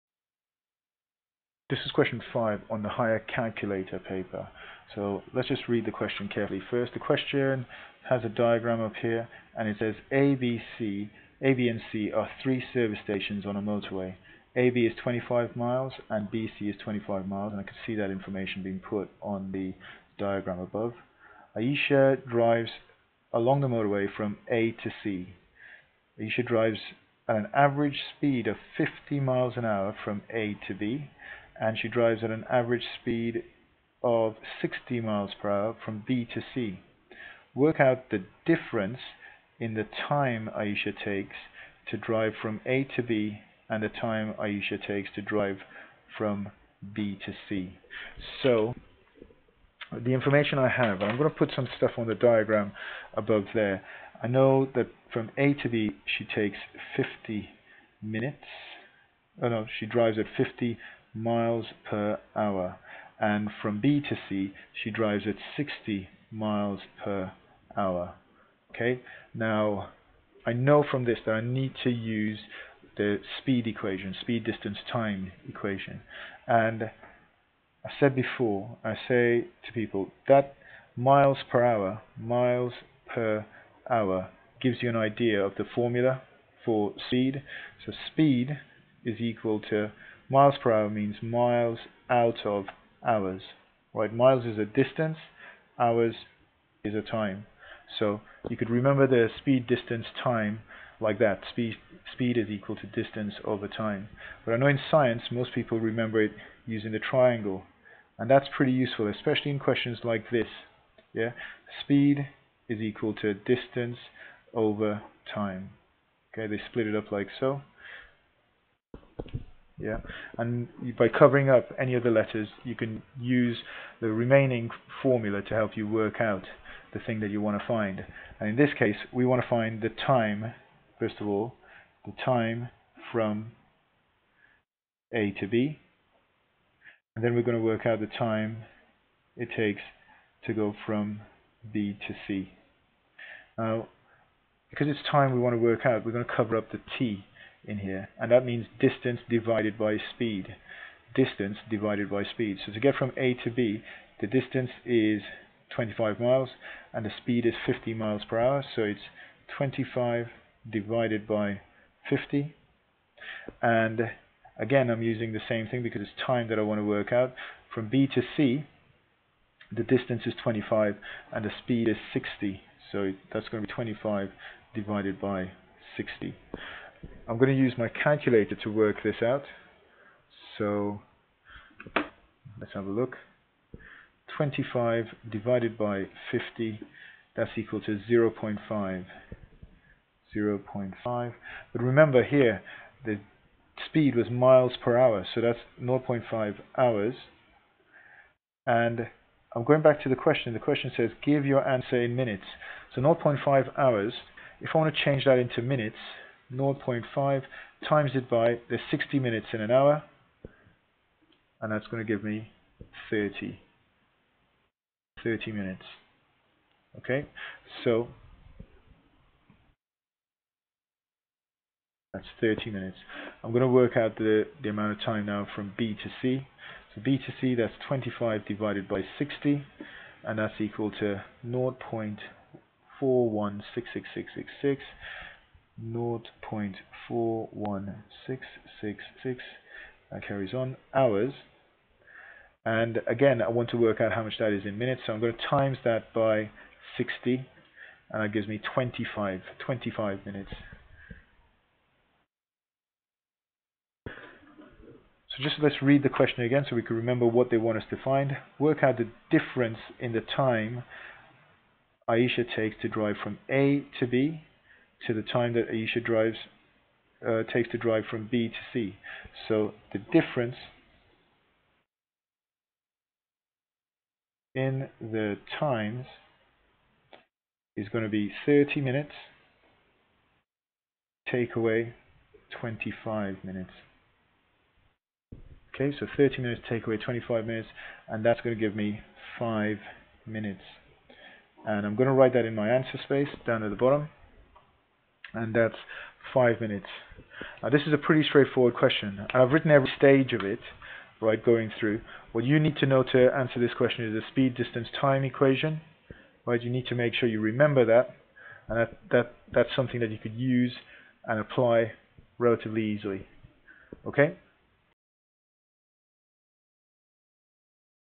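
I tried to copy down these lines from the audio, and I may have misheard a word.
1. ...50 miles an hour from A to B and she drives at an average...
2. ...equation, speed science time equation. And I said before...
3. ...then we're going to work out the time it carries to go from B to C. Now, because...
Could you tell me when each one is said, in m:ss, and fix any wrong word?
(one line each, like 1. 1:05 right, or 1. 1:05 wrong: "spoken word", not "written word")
1. 0:28 right
2. 1:13 wrong: "distance", not "science"
3. 2:17 wrong: "takes", not "carries".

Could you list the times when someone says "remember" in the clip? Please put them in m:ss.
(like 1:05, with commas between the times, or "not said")
1:38, 1:45, 3:11, 4:16, 5:07.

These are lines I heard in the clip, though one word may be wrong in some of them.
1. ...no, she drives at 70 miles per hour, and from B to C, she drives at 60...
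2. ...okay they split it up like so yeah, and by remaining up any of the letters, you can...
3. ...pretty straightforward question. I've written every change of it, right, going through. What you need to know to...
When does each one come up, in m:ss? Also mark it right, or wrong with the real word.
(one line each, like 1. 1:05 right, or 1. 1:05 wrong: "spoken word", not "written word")
1. 0:59 wrong: "50", not "70"
2. 1:56 wrong: "covering", not "remaining"
3. 4:57 wrong: "stage", not "change".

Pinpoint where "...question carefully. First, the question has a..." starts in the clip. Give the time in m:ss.
0:05.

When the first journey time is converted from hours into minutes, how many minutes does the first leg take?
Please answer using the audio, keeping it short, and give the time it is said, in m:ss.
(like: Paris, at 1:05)
30 minutes, at 3:33.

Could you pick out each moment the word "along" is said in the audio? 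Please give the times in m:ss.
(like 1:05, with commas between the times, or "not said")
0:23.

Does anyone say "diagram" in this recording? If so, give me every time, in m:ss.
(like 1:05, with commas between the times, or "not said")
0:08, 0:20, 0:52.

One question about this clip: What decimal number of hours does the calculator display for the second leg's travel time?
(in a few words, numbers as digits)
0.4166666.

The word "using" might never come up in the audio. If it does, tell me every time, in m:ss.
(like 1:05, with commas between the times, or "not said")
1:46, 2:45.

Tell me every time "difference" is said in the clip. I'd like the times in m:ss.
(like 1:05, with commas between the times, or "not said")
0:38, 4:19, 4:29.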